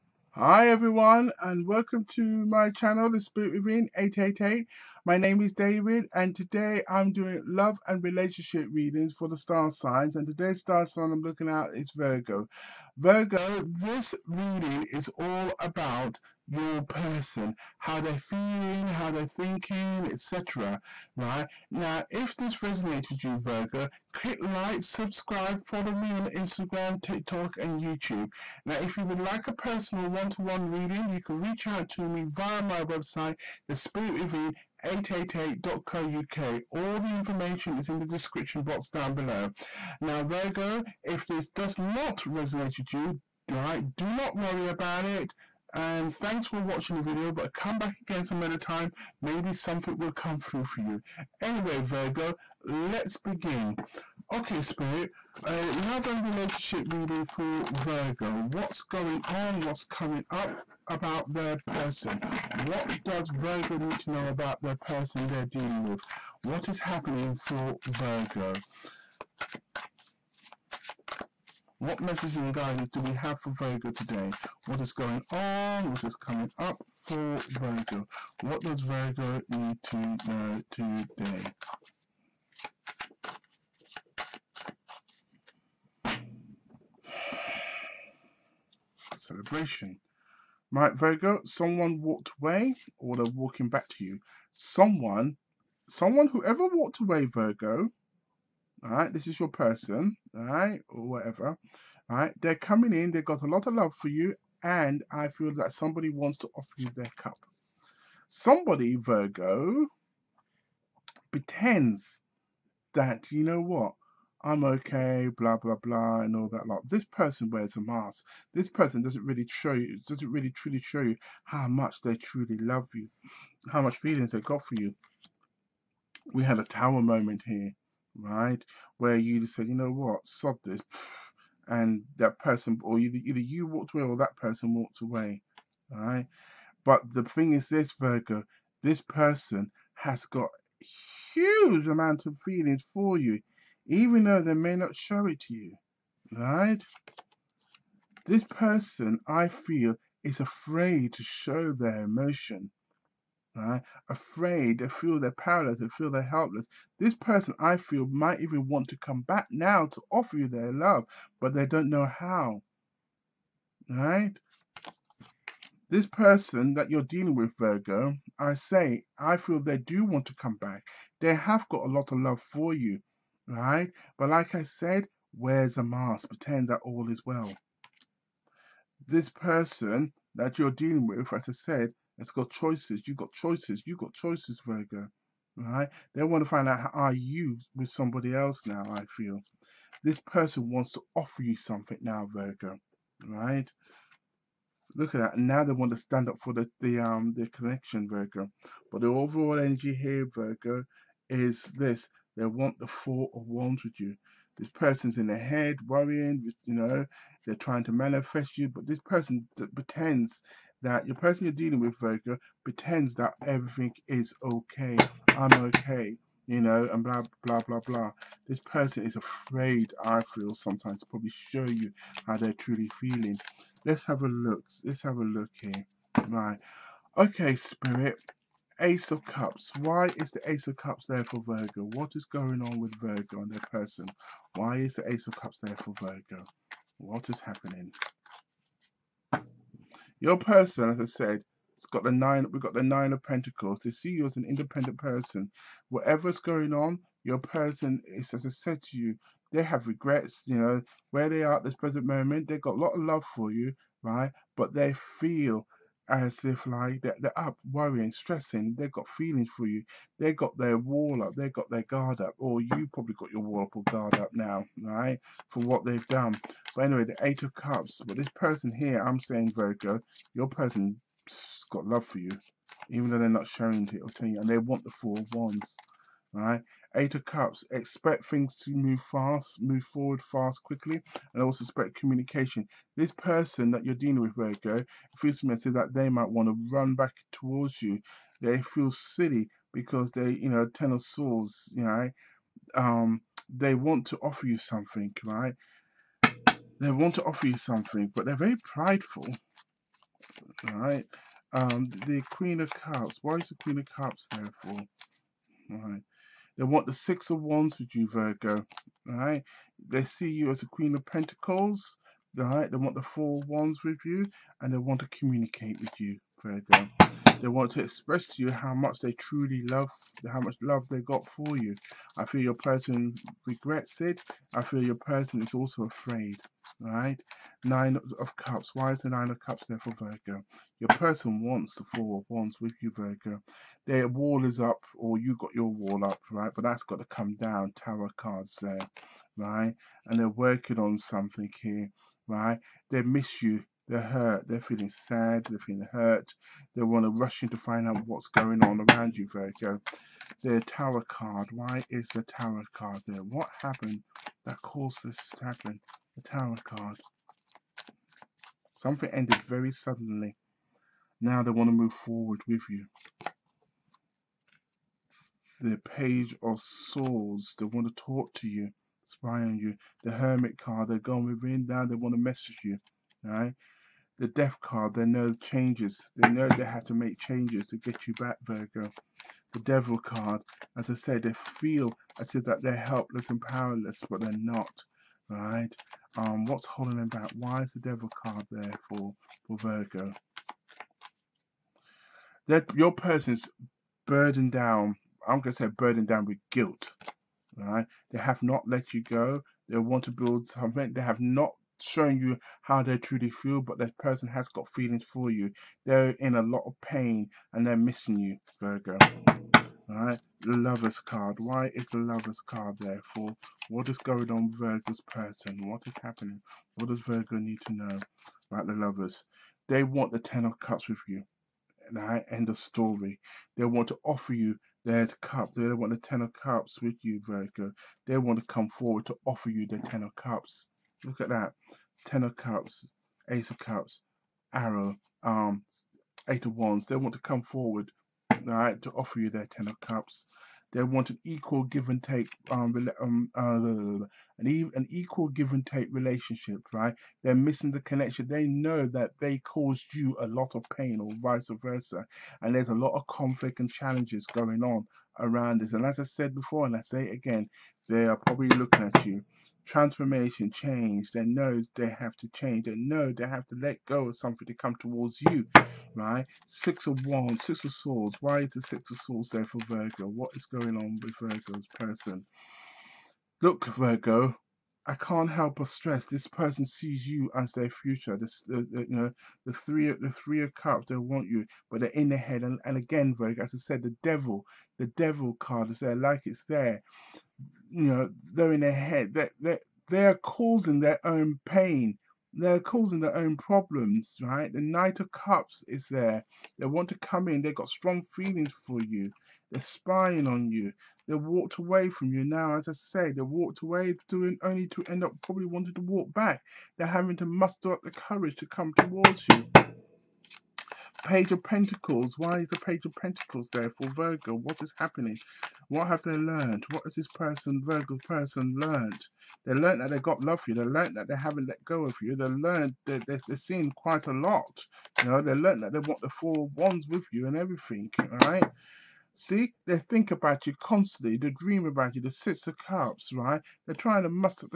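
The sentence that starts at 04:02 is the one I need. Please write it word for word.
We've got the nine of Pentacles.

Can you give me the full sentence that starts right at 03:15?
And now they want to stand up for the, the um the connection, Virgo.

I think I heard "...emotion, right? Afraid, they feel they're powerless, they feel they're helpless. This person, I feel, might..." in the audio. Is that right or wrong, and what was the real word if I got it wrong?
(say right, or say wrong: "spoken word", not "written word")
right.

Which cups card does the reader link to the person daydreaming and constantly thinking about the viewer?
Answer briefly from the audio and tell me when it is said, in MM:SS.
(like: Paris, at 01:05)
Six of Cups, at 08:52.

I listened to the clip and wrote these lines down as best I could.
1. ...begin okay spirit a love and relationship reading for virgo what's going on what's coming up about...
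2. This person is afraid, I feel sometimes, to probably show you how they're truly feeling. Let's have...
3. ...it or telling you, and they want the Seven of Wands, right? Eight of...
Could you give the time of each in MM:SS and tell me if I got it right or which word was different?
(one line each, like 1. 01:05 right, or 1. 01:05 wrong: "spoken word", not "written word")
1. 00:53 right
2. 03:38 right
3. 04:33 wrong: "Four", not "Seven".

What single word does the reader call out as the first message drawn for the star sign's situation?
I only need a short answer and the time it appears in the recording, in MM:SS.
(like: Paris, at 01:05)
Celebration, at 01:29.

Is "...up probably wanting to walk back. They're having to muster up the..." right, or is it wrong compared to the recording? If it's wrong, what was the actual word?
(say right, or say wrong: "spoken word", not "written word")
right.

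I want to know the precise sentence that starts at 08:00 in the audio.
They want you, but they're in their head.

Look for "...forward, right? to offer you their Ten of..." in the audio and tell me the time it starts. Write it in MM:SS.
07:17.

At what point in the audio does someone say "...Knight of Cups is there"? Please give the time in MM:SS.
08:14.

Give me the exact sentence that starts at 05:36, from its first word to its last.
But that's got to come down.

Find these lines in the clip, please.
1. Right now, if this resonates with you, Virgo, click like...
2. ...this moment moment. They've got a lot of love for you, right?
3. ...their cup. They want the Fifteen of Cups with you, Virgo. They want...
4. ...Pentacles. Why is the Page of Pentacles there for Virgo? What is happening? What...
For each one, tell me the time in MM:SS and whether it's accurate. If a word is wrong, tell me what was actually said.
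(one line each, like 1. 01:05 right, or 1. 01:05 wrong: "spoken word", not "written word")
1. 00:21 right
2. 04:11 wrong: "present", not "moment"
3. 07:04 wrong: "Ten", not "Fifteen"
4. 08:31 right.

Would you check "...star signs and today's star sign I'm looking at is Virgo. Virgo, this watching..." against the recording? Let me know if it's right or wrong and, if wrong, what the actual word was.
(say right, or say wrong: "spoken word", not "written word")
wrong: "reading", not "watching".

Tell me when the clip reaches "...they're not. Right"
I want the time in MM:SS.
06:24.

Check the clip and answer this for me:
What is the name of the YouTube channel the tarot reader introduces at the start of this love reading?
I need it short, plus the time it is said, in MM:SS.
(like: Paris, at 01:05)
The Spirit Within 888, at 00:03.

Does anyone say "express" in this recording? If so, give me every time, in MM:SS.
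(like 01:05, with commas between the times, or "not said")
05:17.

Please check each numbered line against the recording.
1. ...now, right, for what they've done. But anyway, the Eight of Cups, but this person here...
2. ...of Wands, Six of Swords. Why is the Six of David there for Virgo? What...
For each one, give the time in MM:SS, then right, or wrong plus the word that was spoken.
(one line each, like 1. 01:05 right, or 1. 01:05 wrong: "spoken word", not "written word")
1. 04:24 right
2. 07:46 wrong: "Swords", not "David".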